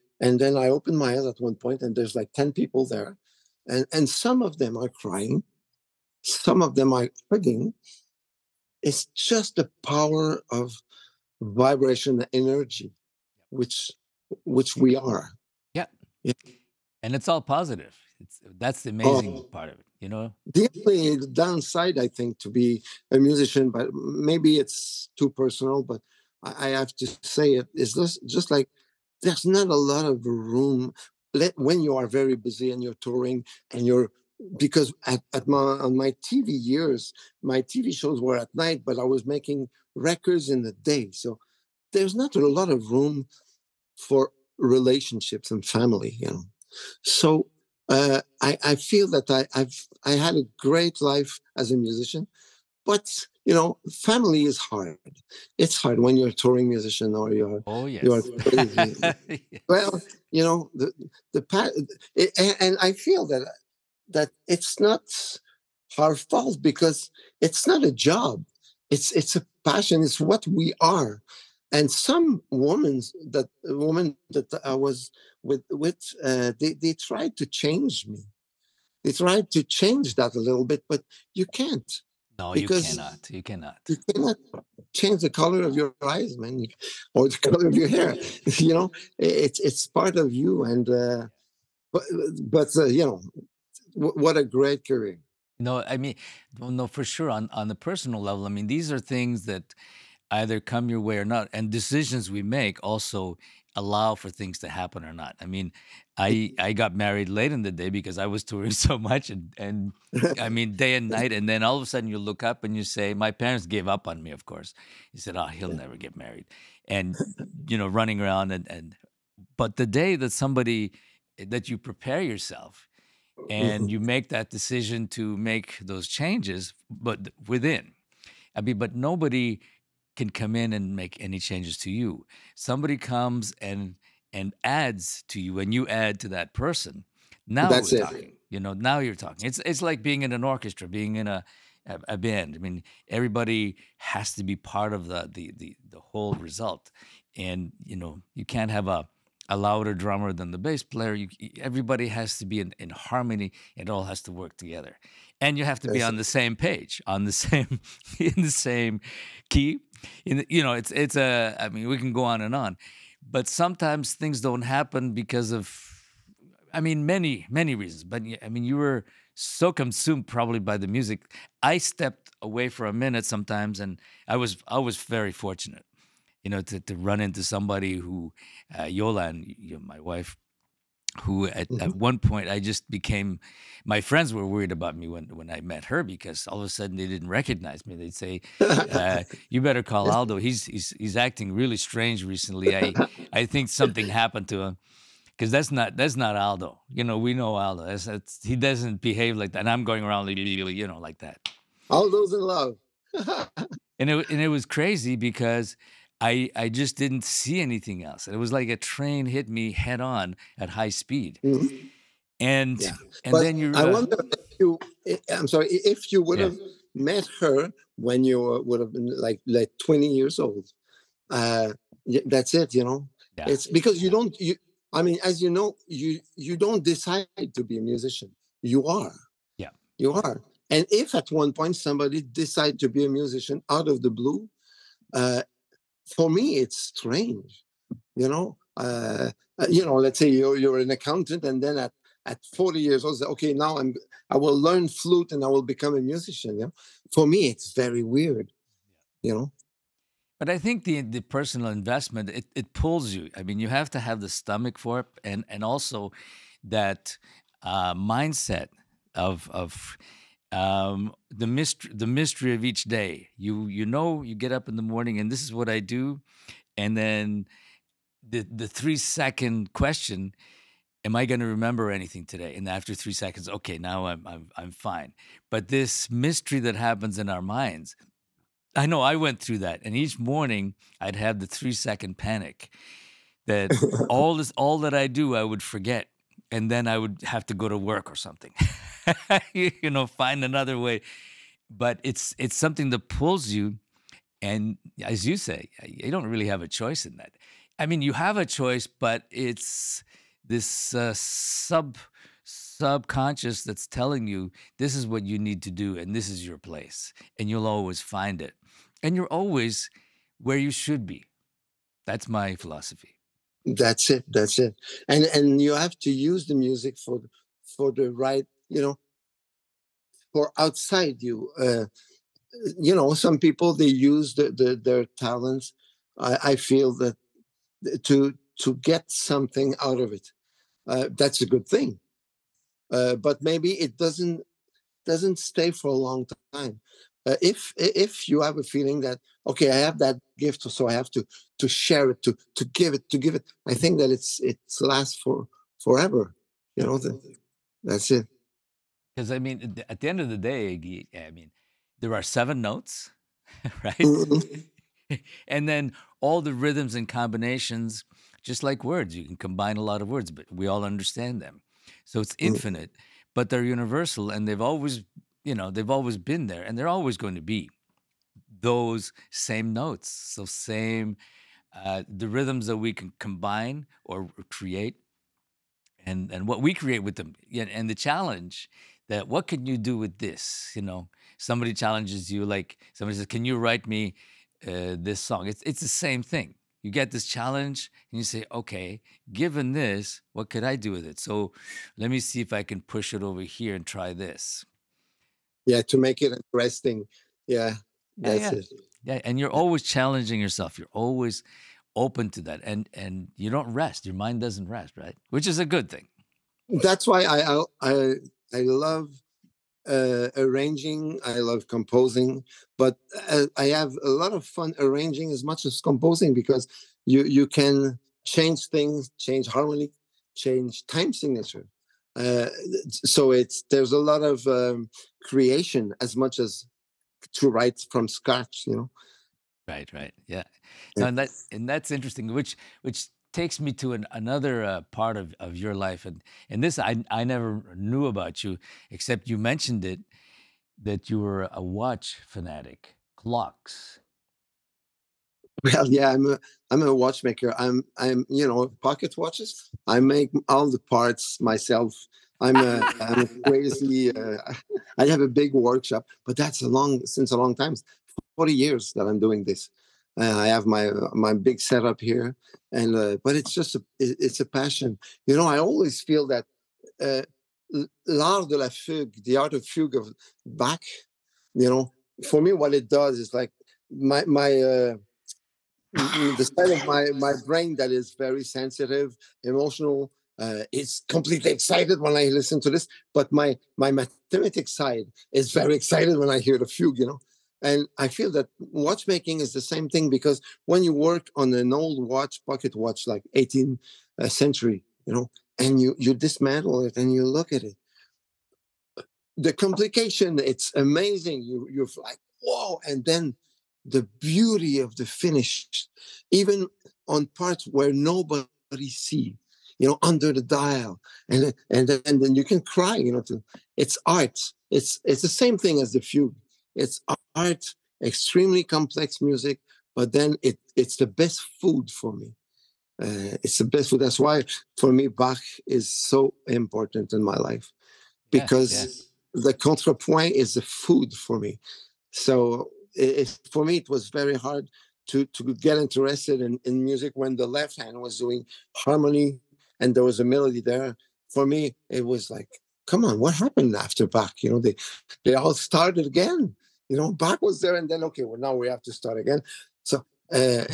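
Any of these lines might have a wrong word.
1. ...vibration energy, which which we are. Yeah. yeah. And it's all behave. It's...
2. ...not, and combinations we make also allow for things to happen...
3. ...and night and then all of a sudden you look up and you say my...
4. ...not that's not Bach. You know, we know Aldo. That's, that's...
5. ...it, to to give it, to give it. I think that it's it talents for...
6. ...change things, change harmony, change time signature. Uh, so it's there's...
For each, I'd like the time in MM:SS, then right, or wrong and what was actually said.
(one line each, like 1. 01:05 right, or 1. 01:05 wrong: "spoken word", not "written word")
1. 00:11 wrong: "positive", not "behave"
2. 01:41 wrong: "decisions", not "combinations"
3. 01:50 right
4. 03:15 wrong: "Aldo", not "Bach"
5. 05:42 wrong: "lasts", not "talents"
6. 06:58 right.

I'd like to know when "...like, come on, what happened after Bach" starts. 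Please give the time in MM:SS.
09:02.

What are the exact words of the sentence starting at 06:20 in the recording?
You know, somebody challenges you, like somebody says, "Can you write me uh, this song?" It's it's the same thing.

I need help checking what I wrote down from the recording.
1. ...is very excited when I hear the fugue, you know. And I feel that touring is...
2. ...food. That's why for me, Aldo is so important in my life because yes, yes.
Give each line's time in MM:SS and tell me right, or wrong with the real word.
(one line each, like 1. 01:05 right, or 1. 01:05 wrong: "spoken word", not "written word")
1. 08:05 wrong: "watchmaking", not "touring"
2. 08:43 wrong: "Bach", not "Aldo".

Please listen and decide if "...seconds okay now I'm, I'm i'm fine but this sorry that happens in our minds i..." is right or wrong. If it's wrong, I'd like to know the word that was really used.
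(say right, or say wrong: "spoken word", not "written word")
wrong: "mystery", not "sorry".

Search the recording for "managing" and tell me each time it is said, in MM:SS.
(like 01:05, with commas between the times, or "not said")
not said.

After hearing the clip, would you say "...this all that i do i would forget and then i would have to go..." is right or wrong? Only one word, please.
right.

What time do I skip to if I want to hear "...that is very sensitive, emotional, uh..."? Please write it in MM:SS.
07:57.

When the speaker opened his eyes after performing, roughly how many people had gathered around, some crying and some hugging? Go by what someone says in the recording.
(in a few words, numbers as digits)
10.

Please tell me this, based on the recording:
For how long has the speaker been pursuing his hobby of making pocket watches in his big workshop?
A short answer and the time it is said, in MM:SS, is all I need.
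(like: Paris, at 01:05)
40 years, at 07:38.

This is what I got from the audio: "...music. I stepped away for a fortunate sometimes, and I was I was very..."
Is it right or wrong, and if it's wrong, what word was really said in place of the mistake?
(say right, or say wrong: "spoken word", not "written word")
wrong: "minute", not "fortunate".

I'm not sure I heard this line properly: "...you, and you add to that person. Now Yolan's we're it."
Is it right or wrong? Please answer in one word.
wrong.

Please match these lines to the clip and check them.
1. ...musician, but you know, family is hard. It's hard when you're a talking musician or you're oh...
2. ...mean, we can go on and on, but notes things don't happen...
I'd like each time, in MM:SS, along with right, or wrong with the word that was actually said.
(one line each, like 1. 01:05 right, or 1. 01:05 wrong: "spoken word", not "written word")
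1. 00:51 wrong: "touring", not "talking"
2. 02:41 wrong: "sometimes", not "notes".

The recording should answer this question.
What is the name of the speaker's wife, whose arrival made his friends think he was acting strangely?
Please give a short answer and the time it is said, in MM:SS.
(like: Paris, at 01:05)
Yolan, at 02:58.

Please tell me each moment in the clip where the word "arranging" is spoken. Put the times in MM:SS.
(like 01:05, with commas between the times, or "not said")
06:50, 06:54.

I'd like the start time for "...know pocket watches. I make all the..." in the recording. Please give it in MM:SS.
07:28.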